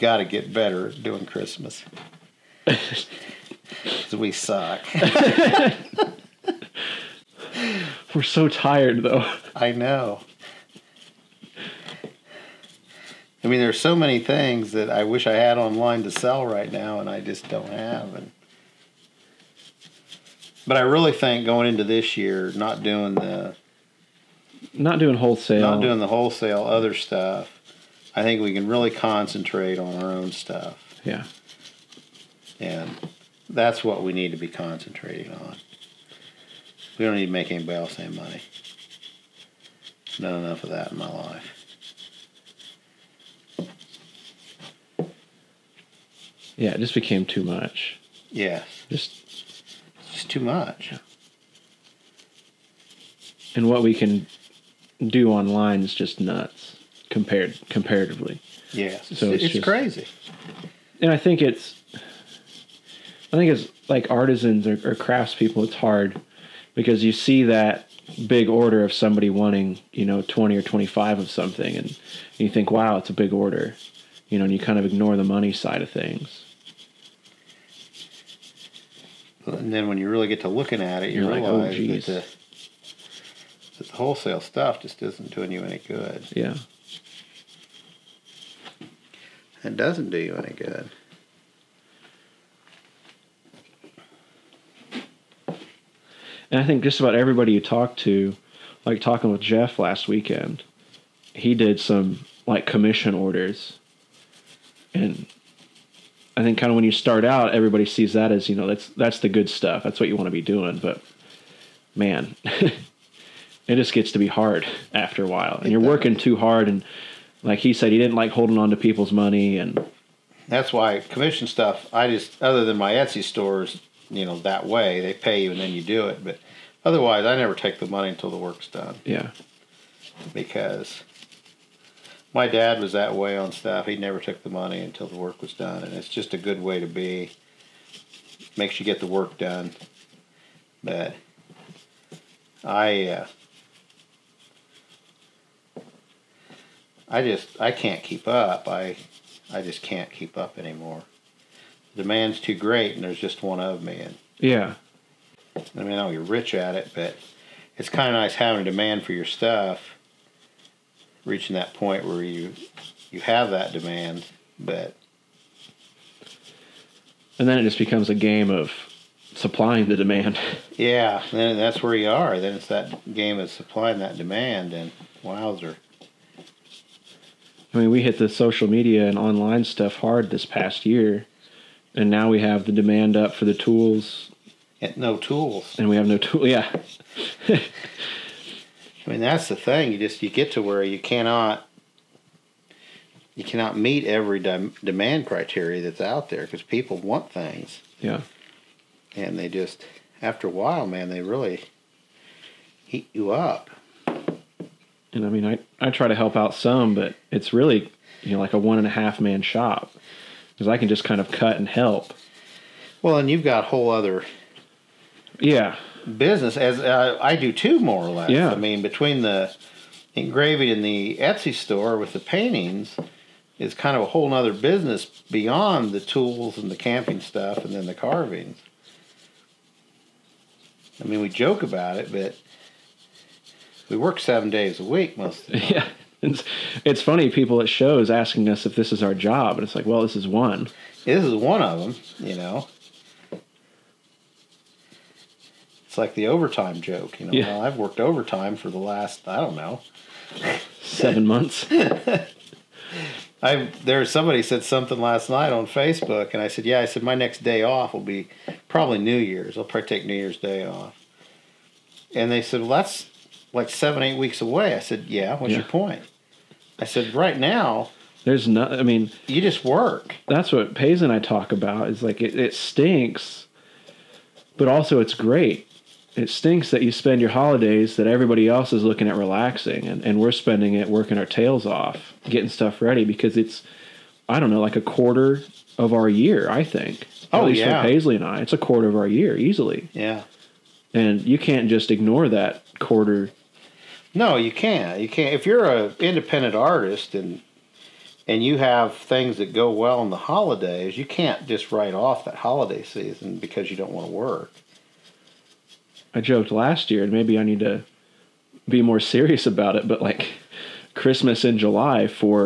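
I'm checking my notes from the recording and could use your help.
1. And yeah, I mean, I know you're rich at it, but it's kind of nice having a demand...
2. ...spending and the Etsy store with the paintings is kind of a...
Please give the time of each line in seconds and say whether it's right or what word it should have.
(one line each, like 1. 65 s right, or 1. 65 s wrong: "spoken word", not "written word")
1. 153 s right
2. 220 s wrong: "engraving", not "spending".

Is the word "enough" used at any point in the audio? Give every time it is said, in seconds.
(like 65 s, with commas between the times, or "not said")
40 s.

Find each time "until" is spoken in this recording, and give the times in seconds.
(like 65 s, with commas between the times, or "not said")
128 s, 134 s.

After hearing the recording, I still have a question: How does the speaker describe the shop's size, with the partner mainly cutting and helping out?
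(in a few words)
one and a half man.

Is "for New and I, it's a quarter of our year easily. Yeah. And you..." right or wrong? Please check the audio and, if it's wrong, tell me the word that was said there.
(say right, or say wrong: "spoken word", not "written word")
wrong: "Paisley", not "New".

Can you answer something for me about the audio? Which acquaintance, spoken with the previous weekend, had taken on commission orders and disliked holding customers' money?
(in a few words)
Jeff.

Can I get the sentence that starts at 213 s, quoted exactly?
Well, and you've got whole other.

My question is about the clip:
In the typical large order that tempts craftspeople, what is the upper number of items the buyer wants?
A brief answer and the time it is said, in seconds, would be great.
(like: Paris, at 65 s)
25, at 70 s.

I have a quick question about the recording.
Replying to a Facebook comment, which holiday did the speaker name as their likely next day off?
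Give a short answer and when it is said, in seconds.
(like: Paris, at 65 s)
New Year's Day, at 260 s.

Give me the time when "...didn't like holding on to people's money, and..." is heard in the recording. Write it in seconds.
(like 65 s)
117 s.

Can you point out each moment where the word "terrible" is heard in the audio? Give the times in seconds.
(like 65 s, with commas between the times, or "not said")
not said.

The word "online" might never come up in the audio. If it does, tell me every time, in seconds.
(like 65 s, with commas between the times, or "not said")
15 s, 55 s, 179 s.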